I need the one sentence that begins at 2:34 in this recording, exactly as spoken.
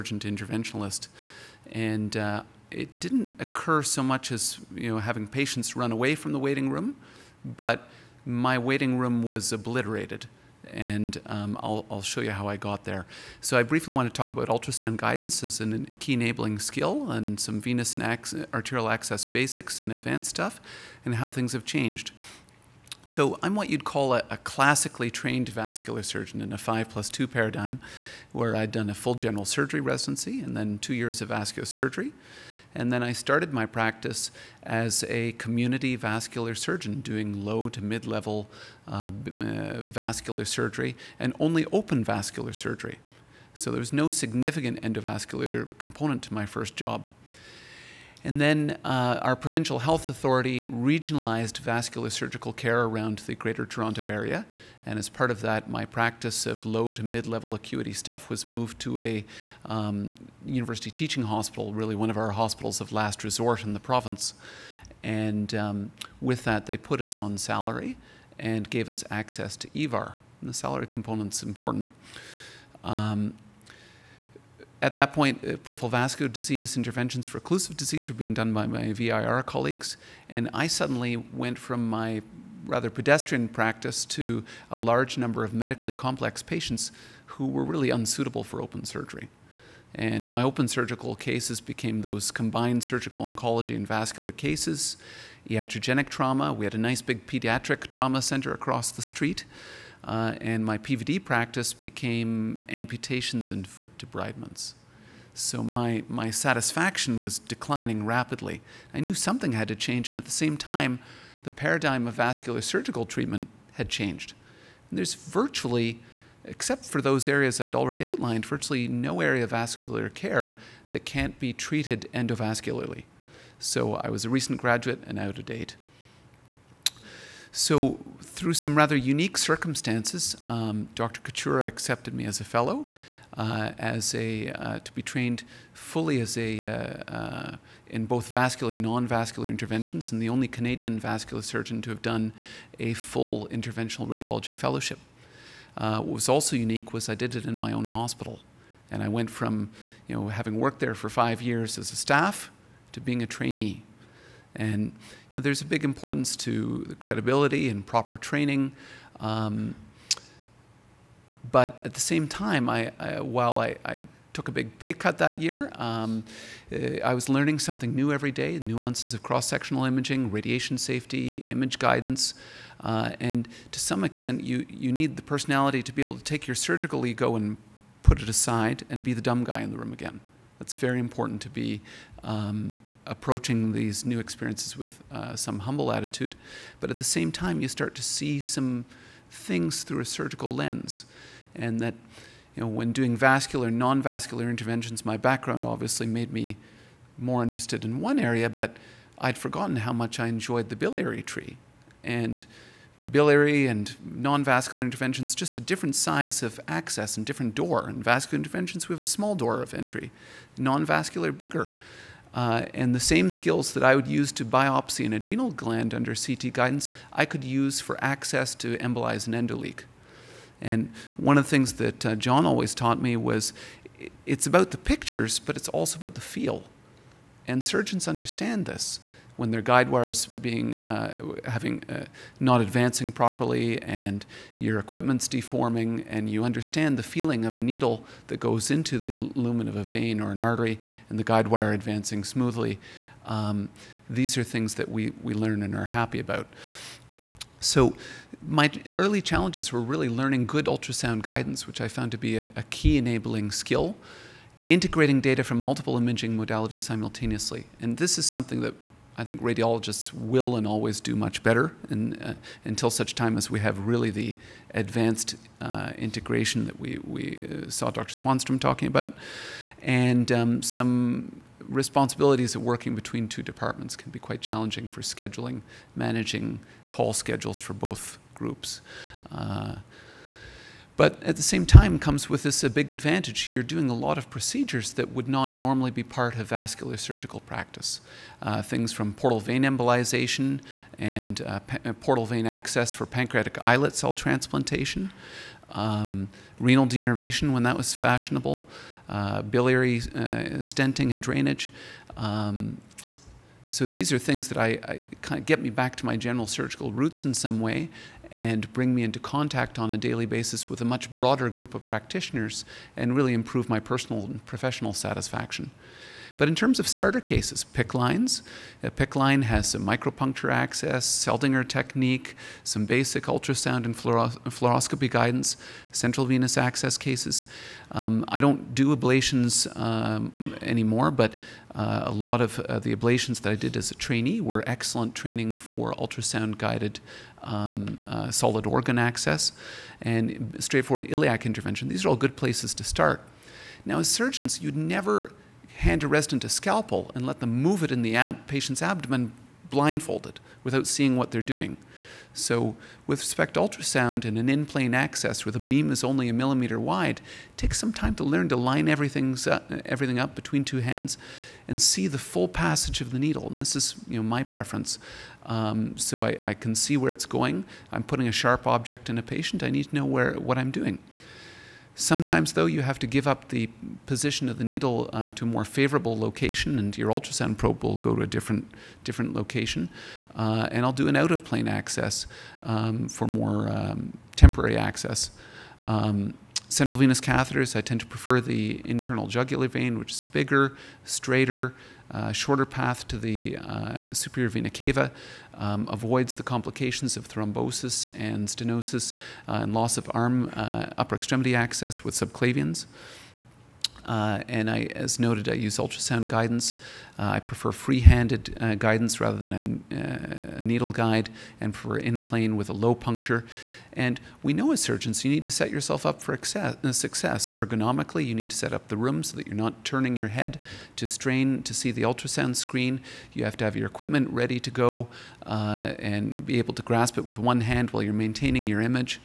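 And you know, there's a big importance to the credibility and proper training.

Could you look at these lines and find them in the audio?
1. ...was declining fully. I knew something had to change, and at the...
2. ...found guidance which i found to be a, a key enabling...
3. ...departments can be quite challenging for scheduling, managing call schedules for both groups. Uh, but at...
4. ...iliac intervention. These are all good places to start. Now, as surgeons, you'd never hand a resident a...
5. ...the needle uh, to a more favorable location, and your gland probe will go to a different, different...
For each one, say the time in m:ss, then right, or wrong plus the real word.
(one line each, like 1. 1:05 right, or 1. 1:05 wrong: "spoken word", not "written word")
1. 1:47 wrong: "rapidly", not "fully"
2. 4:10 wrong: "ultrasound", not "found"
3. 4:33 right
4. 5:41 right
5. 6:14 wrong: "ultrasound", not "gland".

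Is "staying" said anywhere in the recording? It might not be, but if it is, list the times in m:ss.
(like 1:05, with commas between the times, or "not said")
not said.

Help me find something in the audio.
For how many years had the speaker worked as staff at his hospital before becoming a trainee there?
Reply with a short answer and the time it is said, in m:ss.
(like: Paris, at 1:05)
5, at 2:31.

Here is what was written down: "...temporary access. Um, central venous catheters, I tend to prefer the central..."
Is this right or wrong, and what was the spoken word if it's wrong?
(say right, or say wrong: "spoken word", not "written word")
wrong: "internal", not "central".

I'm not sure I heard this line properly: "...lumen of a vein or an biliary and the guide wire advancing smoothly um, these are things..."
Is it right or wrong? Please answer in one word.
wrong.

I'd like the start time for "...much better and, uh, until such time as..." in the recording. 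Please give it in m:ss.
4:21.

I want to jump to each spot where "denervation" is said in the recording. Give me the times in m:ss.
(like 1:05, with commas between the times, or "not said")
4:56.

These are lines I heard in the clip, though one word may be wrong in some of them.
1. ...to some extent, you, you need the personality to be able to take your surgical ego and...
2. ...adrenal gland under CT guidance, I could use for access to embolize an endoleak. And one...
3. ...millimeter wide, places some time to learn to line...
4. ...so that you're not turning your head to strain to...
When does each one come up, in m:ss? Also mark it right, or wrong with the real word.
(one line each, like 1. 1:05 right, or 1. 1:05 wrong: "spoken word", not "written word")
1. 2:53 right
2. 3:35 right
3. 5:56 wrong: "takes", not "places"
4. 6:59 right.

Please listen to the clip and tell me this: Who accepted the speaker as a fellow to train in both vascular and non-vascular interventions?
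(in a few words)
Dr. Kachura.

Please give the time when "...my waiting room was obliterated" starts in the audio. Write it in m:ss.
0:08.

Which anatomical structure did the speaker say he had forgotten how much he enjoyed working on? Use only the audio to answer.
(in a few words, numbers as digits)
biliary tree.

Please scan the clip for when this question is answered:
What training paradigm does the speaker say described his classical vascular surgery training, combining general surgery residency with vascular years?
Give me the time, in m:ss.
0:26.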